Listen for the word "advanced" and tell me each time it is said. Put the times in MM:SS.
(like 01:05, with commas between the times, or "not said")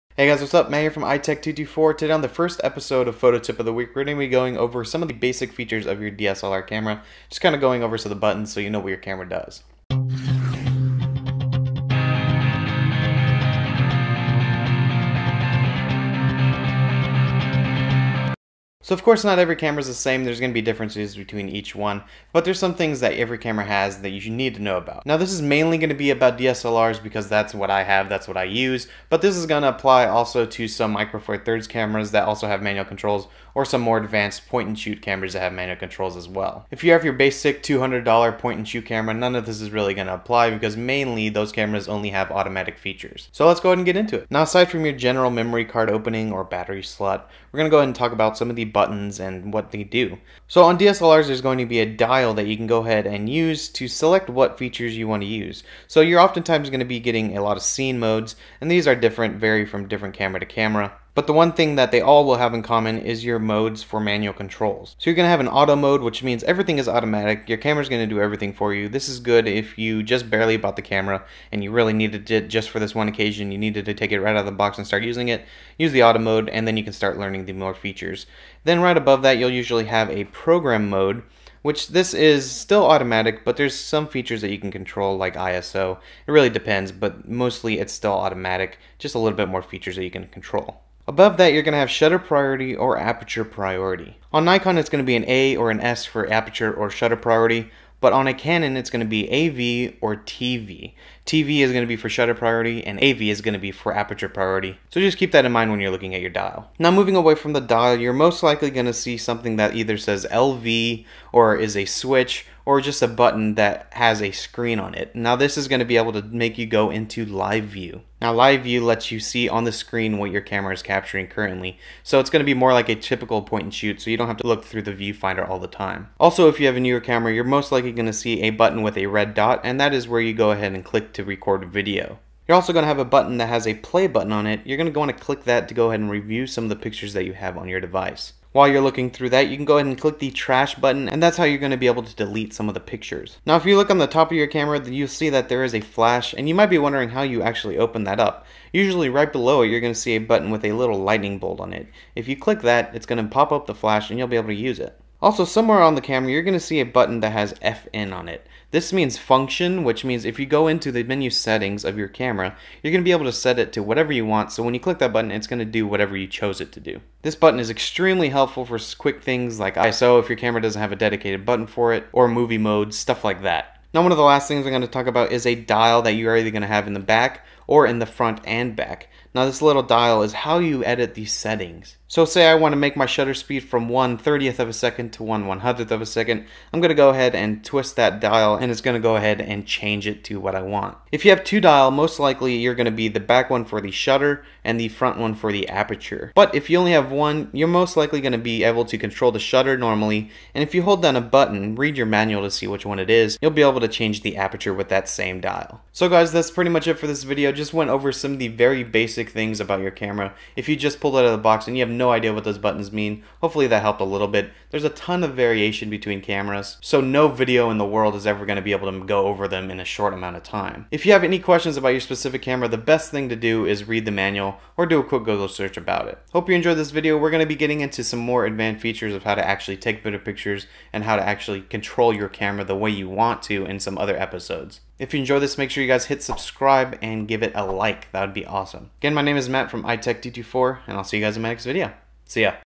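00:33, 03:48.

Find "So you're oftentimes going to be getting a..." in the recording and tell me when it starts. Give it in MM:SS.
00:55.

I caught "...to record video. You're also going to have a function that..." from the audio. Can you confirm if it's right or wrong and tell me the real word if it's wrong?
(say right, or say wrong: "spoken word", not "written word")
wrong: "button", not "function".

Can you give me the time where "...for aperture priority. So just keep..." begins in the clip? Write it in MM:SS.
01:43.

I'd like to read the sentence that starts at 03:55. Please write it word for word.
If you enjoyed this, make sure you guys hit subscribe and give it a like.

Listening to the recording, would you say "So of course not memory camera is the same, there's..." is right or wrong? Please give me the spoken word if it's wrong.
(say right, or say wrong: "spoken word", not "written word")
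wrong: "every", not "memory".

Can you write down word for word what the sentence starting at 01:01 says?
But the one thing that they all will have in common is your modes for manual controls.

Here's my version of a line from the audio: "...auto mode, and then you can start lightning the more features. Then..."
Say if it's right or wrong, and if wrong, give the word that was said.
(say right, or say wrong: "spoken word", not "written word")
wrong: "learning", not "lightning".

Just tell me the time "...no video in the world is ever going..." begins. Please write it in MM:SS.
03:37.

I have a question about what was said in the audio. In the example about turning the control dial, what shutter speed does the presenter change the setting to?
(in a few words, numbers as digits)
1/100th of a second.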